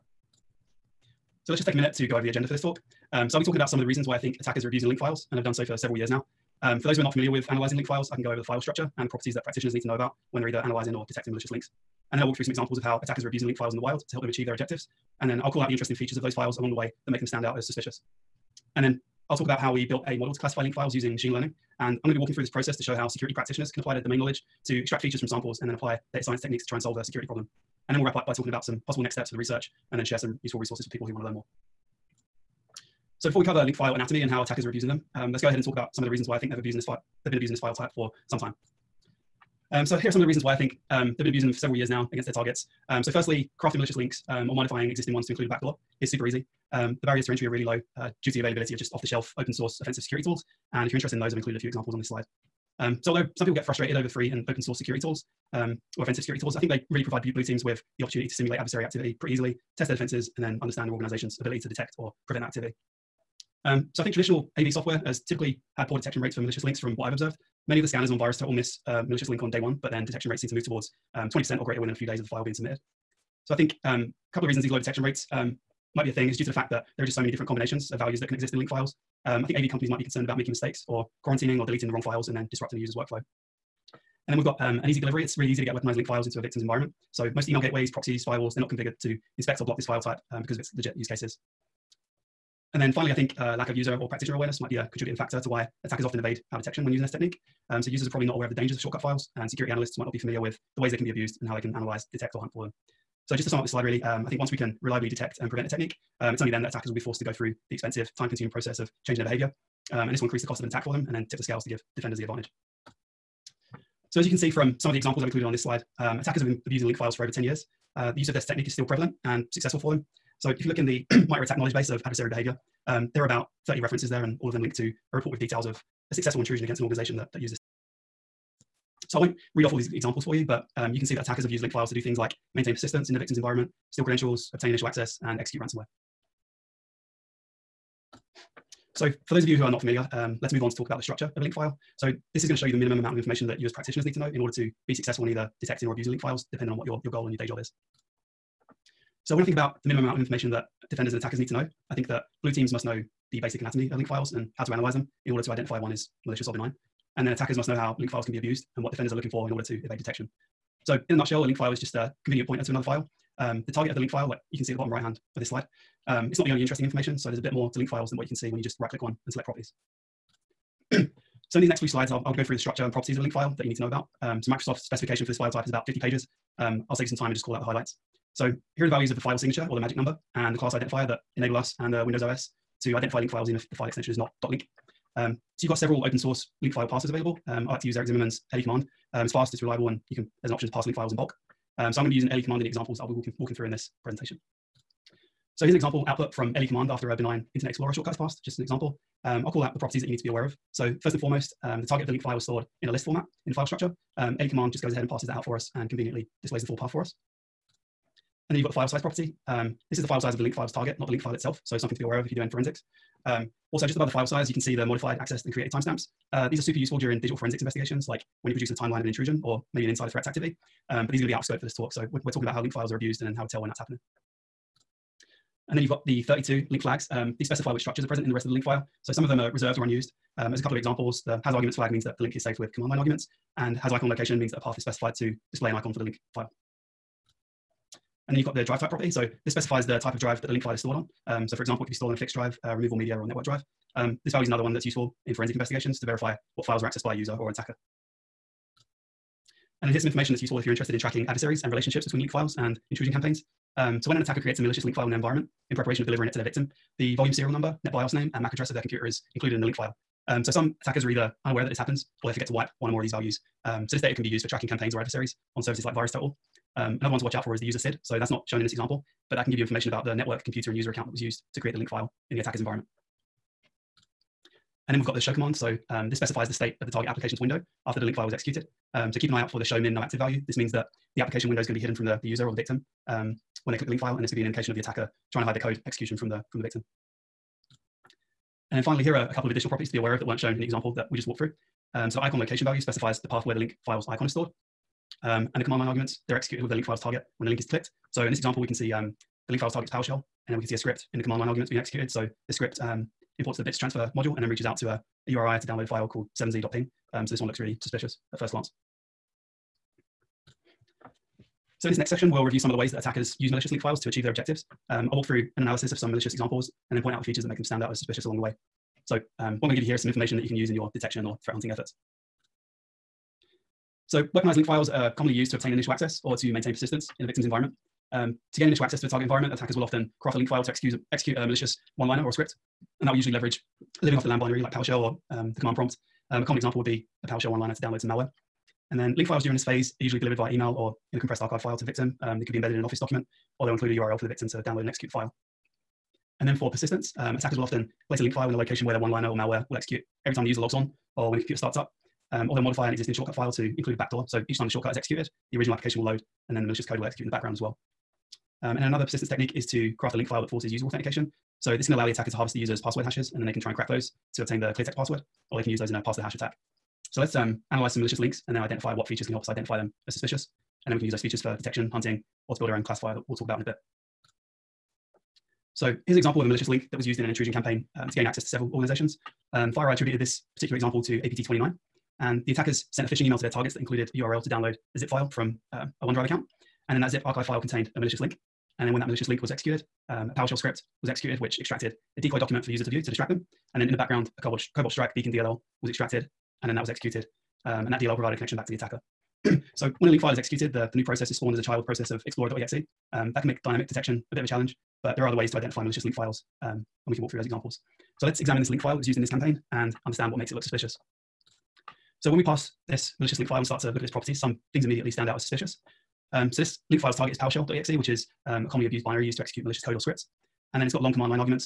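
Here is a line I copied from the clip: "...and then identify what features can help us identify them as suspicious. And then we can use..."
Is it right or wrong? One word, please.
right.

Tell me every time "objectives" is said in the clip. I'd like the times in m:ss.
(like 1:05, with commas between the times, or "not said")
0:14, 5:14.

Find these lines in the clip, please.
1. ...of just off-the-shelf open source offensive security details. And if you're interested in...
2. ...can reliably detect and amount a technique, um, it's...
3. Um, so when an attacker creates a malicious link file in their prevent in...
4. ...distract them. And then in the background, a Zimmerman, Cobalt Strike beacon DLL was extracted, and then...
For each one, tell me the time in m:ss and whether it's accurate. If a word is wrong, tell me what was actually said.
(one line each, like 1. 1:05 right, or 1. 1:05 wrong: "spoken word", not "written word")
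1. 0:48 wrong: "tools", not "details"
2. 1:44 wrong: "prevent", not "amount"
3. 4:13 wrong: "environment", not "prevent"
4. 6:33 wrong: "Cobalt", not "Zimmerman".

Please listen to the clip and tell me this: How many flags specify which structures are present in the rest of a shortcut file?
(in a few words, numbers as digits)
32.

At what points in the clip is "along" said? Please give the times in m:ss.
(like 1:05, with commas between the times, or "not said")
0:16, 5:18.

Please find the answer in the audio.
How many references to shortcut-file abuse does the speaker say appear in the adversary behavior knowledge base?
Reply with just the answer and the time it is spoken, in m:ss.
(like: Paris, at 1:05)
About 30, at 2:03.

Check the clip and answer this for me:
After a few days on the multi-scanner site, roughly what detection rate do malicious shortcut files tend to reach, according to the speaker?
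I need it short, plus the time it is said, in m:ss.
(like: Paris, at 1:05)
20%, at 1:11.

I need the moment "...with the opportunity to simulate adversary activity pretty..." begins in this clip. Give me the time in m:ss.
0:57.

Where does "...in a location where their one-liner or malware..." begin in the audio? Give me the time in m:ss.
5:48.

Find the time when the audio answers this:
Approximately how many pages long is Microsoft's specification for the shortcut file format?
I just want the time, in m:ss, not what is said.
2:55.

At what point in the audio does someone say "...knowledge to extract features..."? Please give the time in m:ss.
0:24.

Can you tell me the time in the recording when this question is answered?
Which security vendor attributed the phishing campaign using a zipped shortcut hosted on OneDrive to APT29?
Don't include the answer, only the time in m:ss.
6:19.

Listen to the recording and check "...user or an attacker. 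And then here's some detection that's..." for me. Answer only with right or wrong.
wrong.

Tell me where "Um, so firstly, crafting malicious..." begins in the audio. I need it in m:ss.
0:42.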